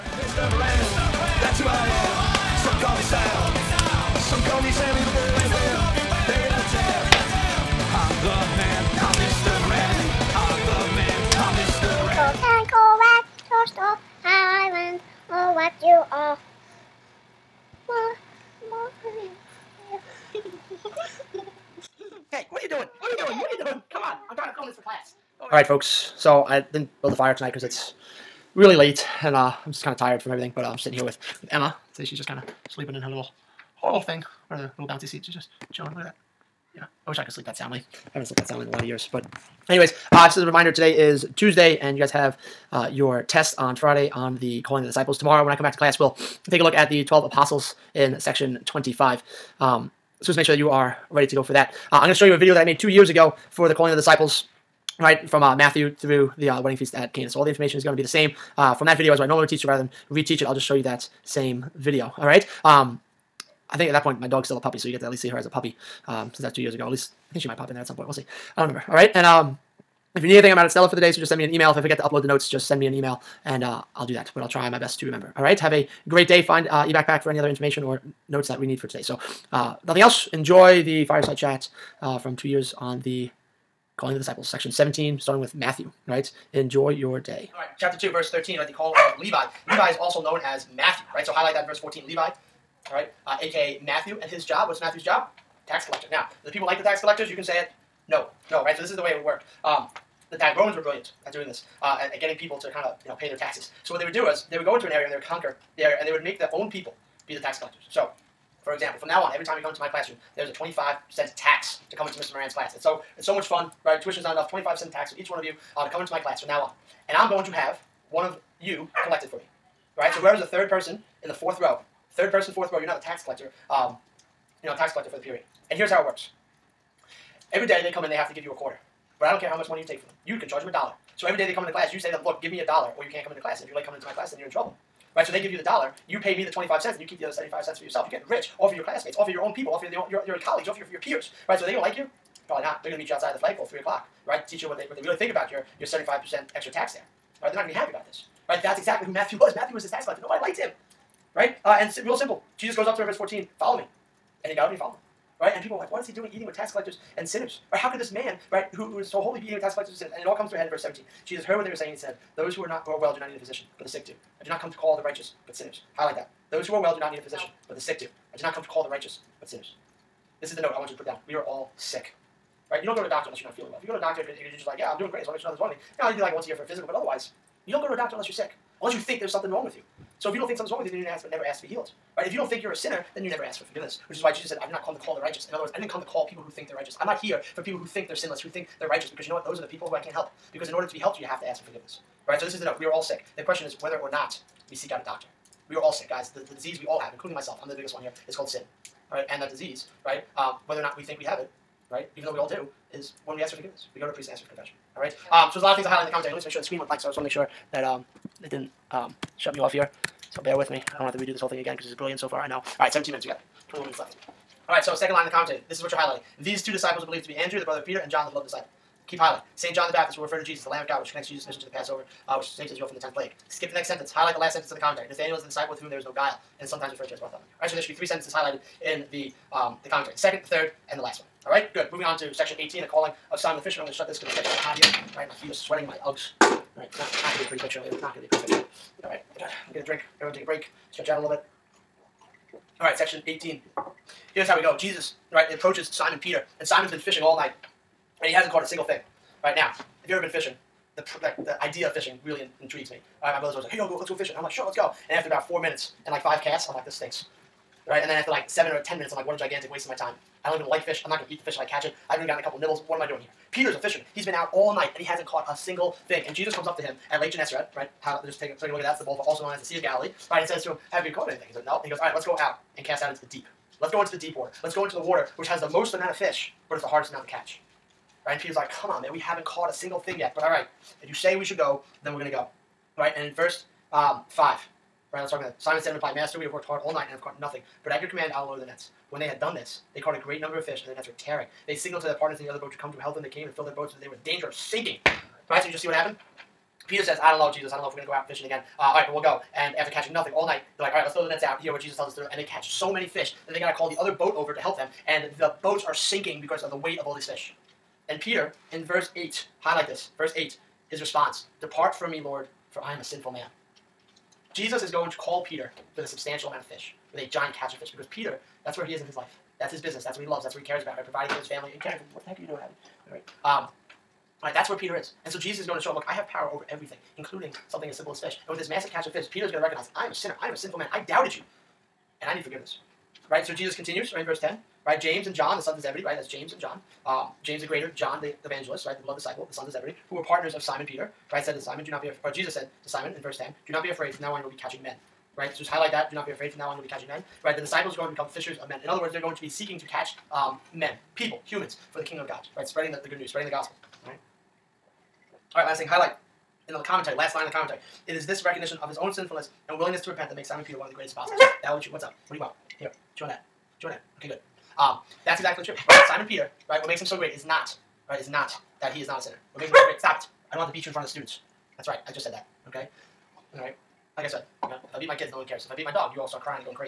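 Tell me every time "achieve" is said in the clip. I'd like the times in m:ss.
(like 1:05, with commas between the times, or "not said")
not said.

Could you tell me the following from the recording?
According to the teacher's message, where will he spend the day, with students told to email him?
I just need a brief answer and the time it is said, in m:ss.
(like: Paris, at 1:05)
Stella, at 1:10.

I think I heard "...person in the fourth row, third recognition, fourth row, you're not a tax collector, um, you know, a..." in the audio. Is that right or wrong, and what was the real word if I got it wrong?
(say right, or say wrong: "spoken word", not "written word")
wrong: "person", not "recognition".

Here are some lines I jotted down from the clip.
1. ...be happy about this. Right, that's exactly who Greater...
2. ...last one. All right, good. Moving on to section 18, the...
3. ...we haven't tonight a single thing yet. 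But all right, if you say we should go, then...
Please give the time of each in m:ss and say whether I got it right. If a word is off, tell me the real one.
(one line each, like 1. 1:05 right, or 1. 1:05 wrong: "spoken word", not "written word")
1. 2:27 wrong: "Matthew", not "Greater"
2. 3:51 right
3. 4:39 wrong: "caught", not "tonight".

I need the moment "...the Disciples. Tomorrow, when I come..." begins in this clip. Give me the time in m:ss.
0:44.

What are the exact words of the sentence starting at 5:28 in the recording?
And with this massive catch of fish, Peter is going to recognize, I am a sinner.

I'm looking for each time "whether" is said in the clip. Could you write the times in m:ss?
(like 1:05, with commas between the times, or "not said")
3:13, 3:20.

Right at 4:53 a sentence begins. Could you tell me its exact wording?
They came and filled their boats so that they were in danger of sinking.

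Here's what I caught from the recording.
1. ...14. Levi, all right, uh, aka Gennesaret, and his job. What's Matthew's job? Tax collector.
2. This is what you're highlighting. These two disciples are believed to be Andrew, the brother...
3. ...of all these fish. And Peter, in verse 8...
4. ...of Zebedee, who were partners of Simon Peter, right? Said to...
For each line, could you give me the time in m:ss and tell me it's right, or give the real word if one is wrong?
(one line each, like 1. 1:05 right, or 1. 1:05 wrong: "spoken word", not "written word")
1. 1:31 wrong: "Matthew", not "Gennesaret"
2. 3:35 right
3. 5:06 right
4. 5:39 right.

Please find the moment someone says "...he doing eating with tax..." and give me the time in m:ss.
2:36.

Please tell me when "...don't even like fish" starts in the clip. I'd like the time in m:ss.
4:20.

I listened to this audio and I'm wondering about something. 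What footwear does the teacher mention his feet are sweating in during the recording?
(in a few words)
Uggs.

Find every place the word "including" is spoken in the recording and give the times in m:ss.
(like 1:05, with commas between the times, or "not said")
3:17, 5:27.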